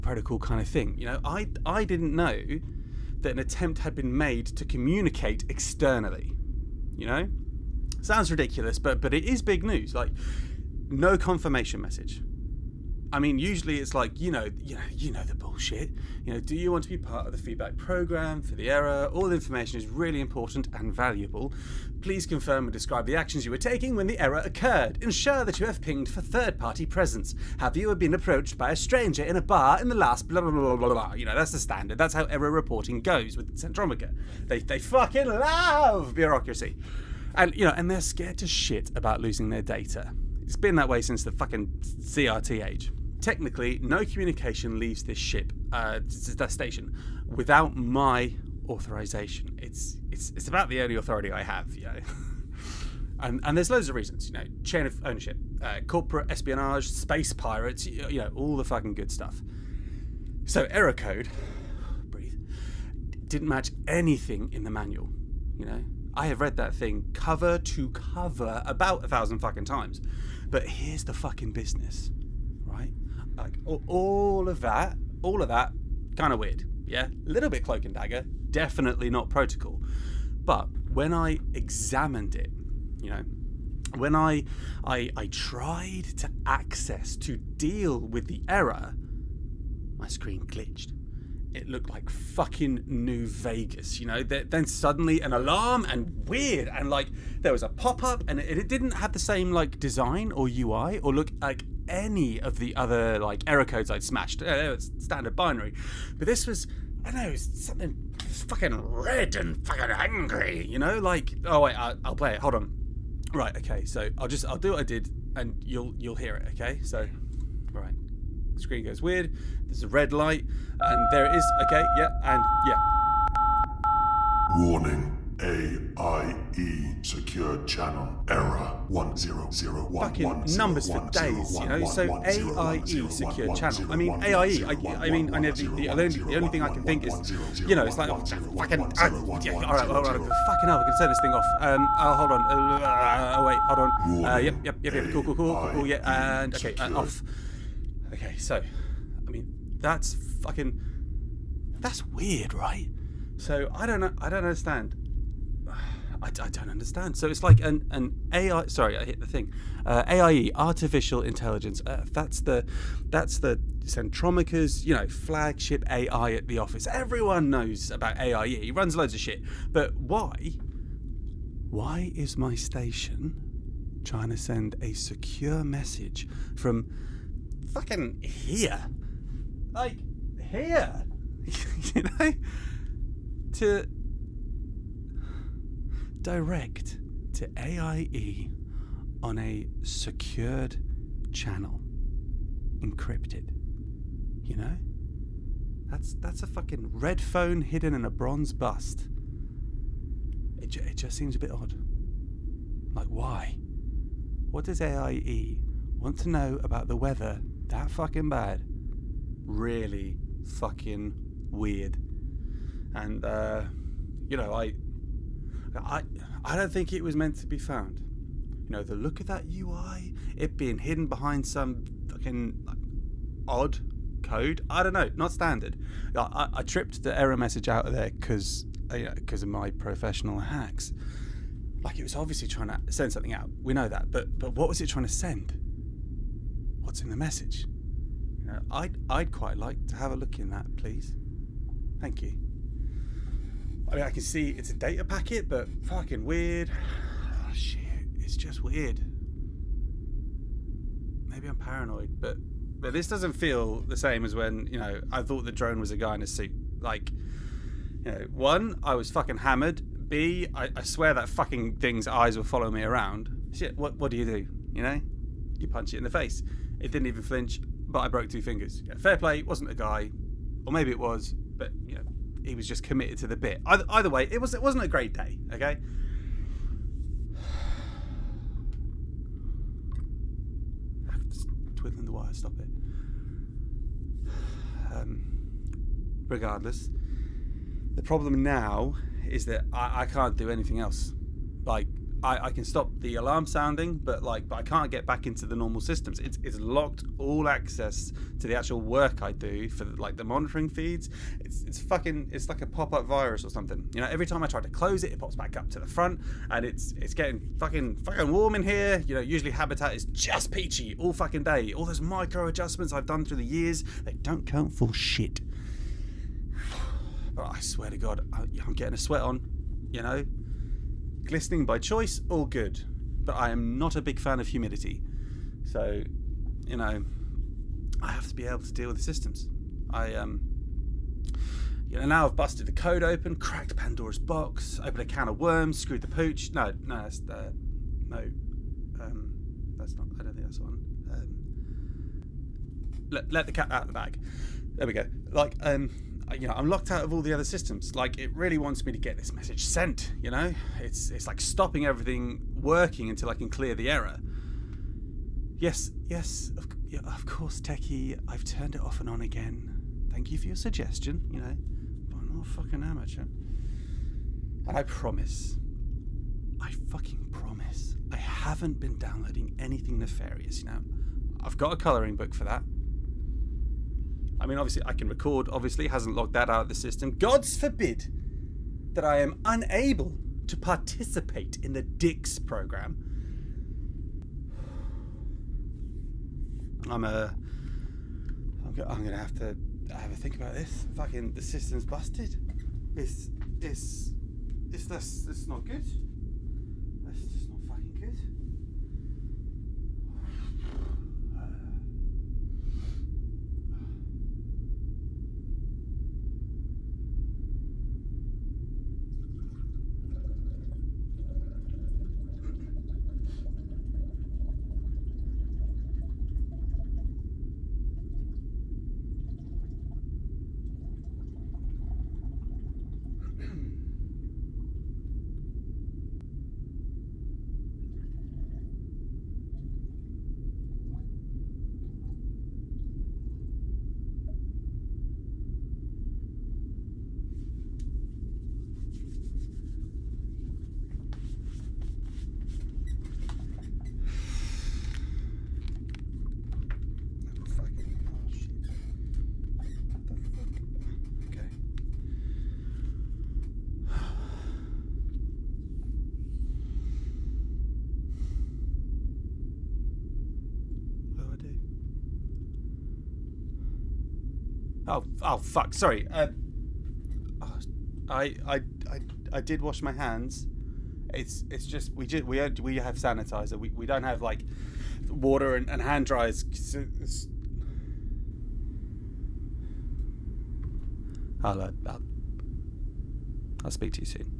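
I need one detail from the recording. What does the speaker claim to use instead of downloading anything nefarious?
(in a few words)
a colouring book.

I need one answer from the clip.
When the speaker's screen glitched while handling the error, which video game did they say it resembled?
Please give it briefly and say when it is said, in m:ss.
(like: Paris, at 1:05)
New Vegas, at 1:32.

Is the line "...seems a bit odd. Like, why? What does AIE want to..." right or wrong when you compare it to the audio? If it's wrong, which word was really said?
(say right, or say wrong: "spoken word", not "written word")
right.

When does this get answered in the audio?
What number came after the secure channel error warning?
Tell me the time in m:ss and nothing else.
2:08.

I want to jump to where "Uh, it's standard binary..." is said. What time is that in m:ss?
1:44.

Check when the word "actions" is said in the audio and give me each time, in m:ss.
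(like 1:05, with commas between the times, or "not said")
0:23.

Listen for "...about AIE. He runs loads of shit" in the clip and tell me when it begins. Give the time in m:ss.
2:47.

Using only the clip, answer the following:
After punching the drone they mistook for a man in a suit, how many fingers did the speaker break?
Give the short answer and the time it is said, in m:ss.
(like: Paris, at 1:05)
2, at 4:28.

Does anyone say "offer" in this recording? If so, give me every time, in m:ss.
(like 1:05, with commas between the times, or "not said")
not said.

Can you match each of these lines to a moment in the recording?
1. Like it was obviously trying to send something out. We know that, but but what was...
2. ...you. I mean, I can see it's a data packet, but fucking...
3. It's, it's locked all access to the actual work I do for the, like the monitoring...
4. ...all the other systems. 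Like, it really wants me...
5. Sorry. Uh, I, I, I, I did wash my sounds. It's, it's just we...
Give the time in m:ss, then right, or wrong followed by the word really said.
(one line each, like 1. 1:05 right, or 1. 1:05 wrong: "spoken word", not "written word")
1. 3:51 right
2. 4:02 right
3. 4:56 right
4. 5:47 right
5. 7:45 wrong: "hands", not "sounds".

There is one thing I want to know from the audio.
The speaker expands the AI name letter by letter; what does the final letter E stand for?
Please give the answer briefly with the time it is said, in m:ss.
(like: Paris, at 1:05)
Earth, at 2:41.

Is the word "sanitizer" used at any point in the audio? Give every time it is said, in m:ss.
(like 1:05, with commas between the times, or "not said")
7:52.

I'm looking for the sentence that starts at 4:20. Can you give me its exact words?
B, I, I swear that fucking thing's eyes were following me around.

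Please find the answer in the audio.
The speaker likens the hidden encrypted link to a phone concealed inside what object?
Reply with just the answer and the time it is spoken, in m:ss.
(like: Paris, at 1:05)
bronze bust, at 3:18.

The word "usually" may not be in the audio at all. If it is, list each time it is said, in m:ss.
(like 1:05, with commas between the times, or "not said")
0:13, 5:09.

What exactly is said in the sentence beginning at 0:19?
All the information is really important and valuable.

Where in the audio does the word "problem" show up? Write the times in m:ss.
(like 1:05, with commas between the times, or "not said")
4:48.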